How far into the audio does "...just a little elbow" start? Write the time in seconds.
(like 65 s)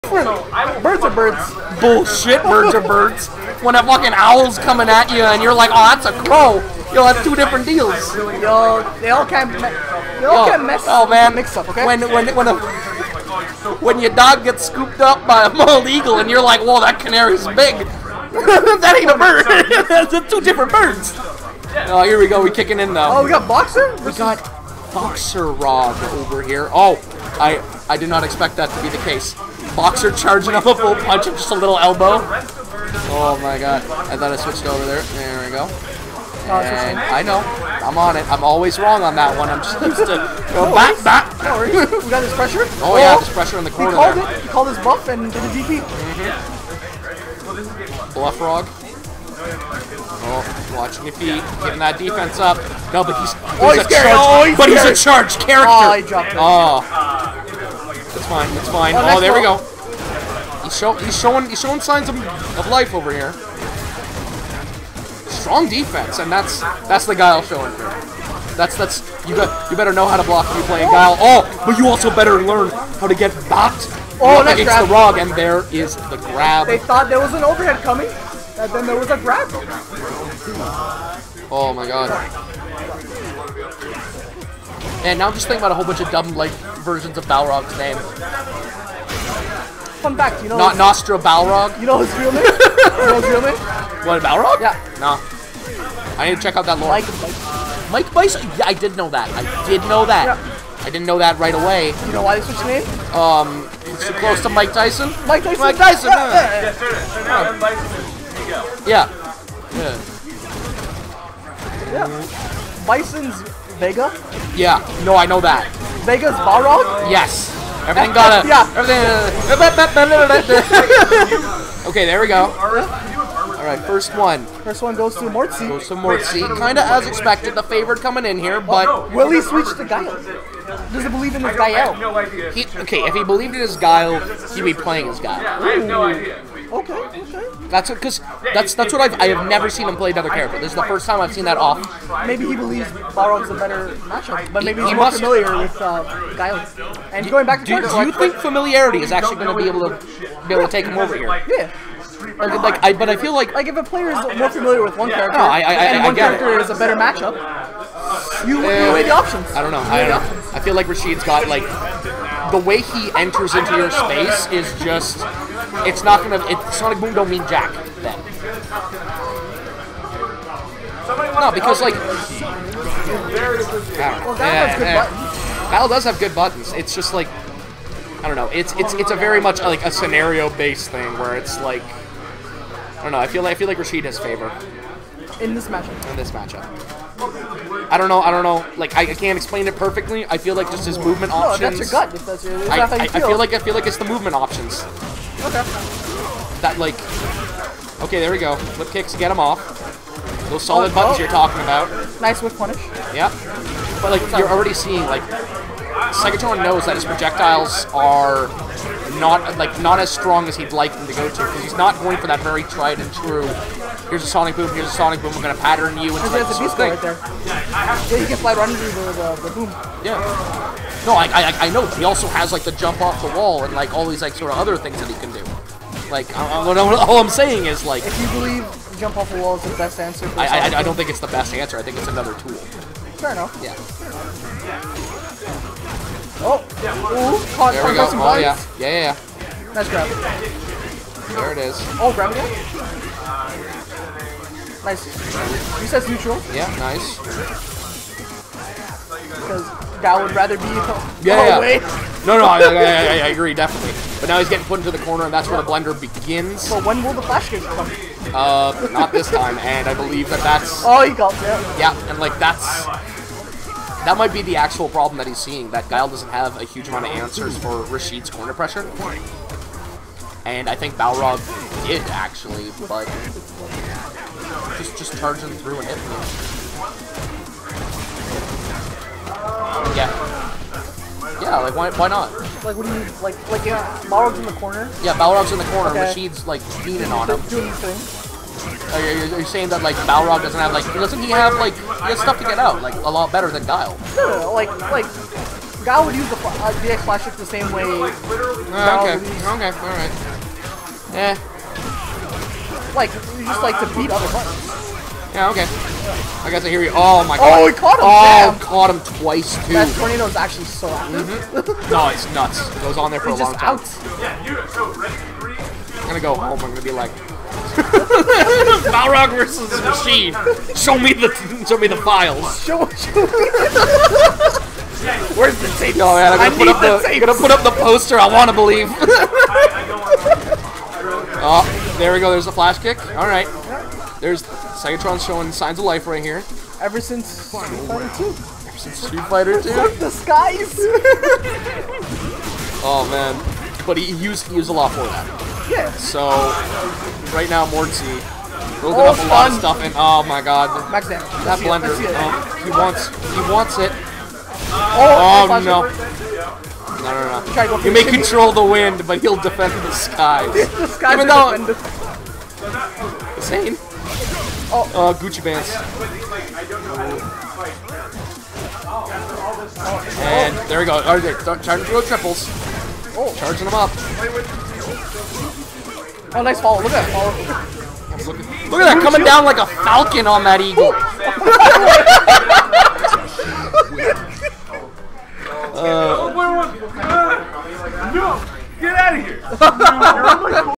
31 s.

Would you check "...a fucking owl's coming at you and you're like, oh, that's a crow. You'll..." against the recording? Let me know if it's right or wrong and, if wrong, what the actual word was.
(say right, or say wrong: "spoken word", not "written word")
right.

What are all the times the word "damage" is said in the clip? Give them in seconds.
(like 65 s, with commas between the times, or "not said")
351 s.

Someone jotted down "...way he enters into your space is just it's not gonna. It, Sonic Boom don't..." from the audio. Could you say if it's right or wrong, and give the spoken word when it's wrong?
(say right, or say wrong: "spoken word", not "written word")
right.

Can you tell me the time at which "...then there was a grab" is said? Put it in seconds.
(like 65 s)
78 s.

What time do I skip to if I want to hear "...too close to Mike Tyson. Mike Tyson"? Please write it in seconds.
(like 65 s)
104 s.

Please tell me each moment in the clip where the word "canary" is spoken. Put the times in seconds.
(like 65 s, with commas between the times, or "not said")
16 s.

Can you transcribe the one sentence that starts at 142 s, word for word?
Maybe he believes Balrog's a better matchup, but maybe he, he's more must.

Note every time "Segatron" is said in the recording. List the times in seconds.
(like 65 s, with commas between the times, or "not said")
206 s, 334 s.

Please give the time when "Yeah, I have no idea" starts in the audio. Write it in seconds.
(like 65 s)
135 s.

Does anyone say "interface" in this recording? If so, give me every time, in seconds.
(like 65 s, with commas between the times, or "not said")
not said.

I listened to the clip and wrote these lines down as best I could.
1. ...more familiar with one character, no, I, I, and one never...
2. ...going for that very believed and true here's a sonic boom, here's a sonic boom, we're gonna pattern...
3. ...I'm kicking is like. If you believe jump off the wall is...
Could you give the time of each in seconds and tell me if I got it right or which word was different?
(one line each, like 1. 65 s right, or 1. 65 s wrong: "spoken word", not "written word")
1. 154 s wrong: "character", not "never"
2. 212 s wrong: "tried", not "believed"
3. 227 s wrong: "saying", not "kicking".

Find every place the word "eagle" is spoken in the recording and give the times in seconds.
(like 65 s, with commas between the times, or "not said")
15 s, 380 s.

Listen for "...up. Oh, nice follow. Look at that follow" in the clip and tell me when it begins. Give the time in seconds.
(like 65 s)
373 s.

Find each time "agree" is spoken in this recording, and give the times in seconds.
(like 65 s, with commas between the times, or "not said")
253 s.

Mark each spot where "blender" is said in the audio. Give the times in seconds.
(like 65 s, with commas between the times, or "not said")
255 s, 351 s.